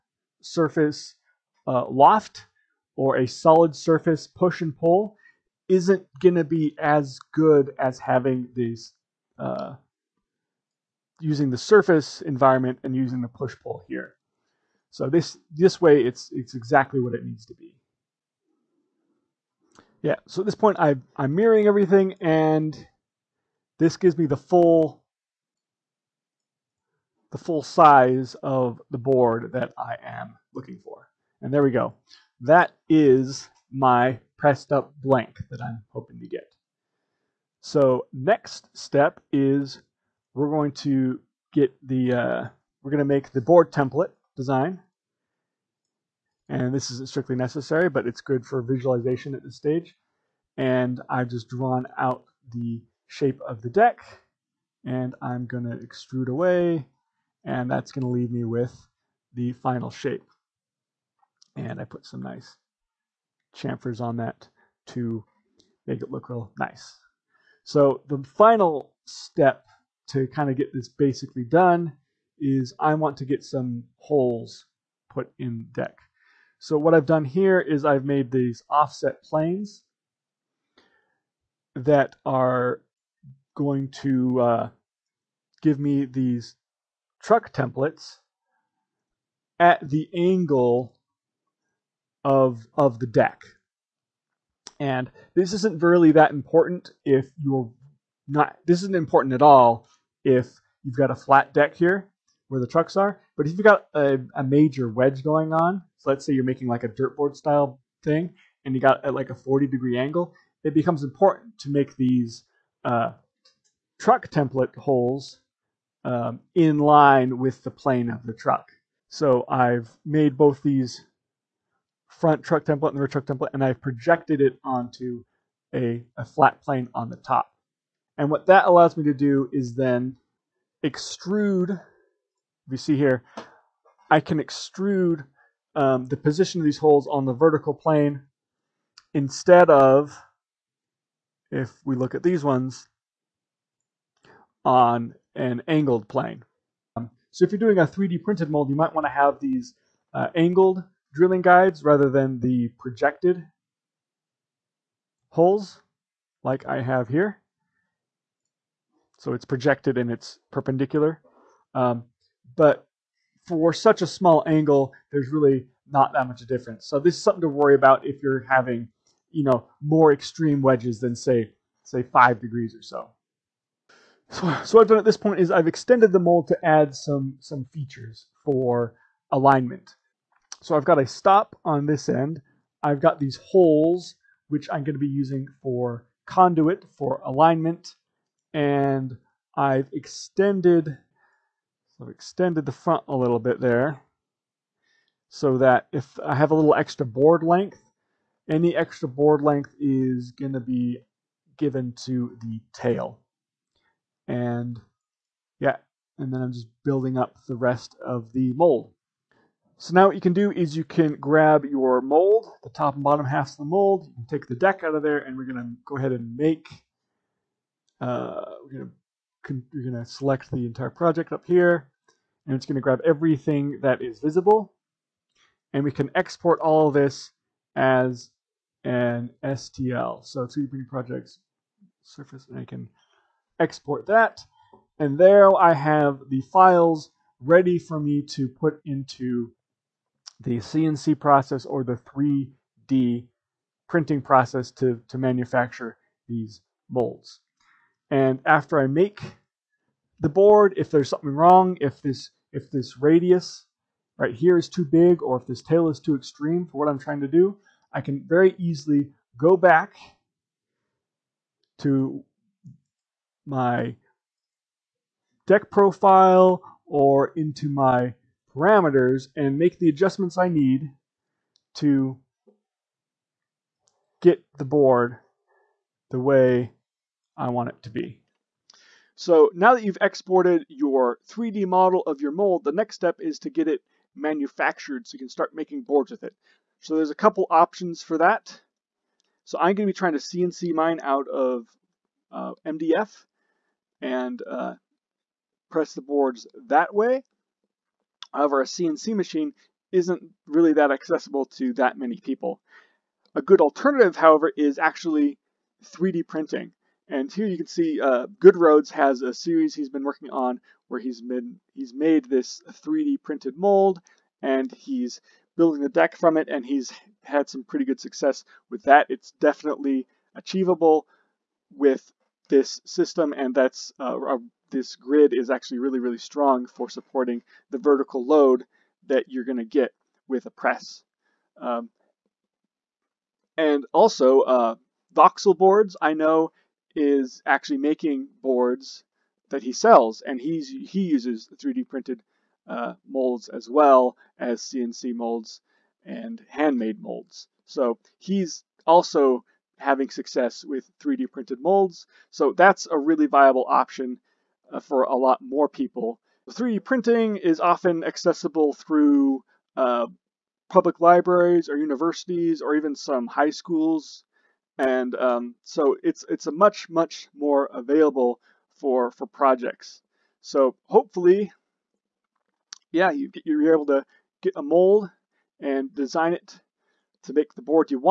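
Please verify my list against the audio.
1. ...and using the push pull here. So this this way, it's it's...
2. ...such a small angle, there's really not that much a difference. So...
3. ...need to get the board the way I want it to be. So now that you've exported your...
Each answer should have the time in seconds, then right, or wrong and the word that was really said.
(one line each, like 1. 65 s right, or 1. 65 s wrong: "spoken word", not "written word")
1. 12 s right
2. 163 s right
3. 270 s right.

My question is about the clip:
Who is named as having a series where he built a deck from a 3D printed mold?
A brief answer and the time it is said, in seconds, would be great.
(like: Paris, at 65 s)
Goodroads, at 308 s.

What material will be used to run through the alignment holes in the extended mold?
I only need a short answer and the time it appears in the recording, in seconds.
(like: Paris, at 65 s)
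conduit, at 186 s.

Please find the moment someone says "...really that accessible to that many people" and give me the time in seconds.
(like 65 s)
300 s.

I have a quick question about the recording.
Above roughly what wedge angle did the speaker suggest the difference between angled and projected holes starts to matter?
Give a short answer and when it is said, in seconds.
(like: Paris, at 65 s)
5 degrees, at 172 s.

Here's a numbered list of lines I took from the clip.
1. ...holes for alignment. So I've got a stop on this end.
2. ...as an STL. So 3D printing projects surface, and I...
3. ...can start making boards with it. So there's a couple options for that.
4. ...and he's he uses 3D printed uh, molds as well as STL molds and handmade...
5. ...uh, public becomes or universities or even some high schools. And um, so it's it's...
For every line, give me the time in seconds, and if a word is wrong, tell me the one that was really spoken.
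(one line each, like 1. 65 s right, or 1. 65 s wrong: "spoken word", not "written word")
1. 177 s wrong: "features", not "holes"
2. 227 s right
3. 285 s right
4. 340 s wrong: "CNC", not "STL"
5. 359 s wrong: "libraries", not "becomes".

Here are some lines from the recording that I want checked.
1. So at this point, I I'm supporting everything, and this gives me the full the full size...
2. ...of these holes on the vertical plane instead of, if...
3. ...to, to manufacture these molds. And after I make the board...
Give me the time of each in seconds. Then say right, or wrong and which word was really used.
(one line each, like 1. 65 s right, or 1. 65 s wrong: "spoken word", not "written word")
1. 20 s wrong: "mirroring", not "supporting"
2. 136 s right
3. 244 s right.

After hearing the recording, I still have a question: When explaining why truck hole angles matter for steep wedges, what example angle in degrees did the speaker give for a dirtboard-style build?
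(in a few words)
40 degrees.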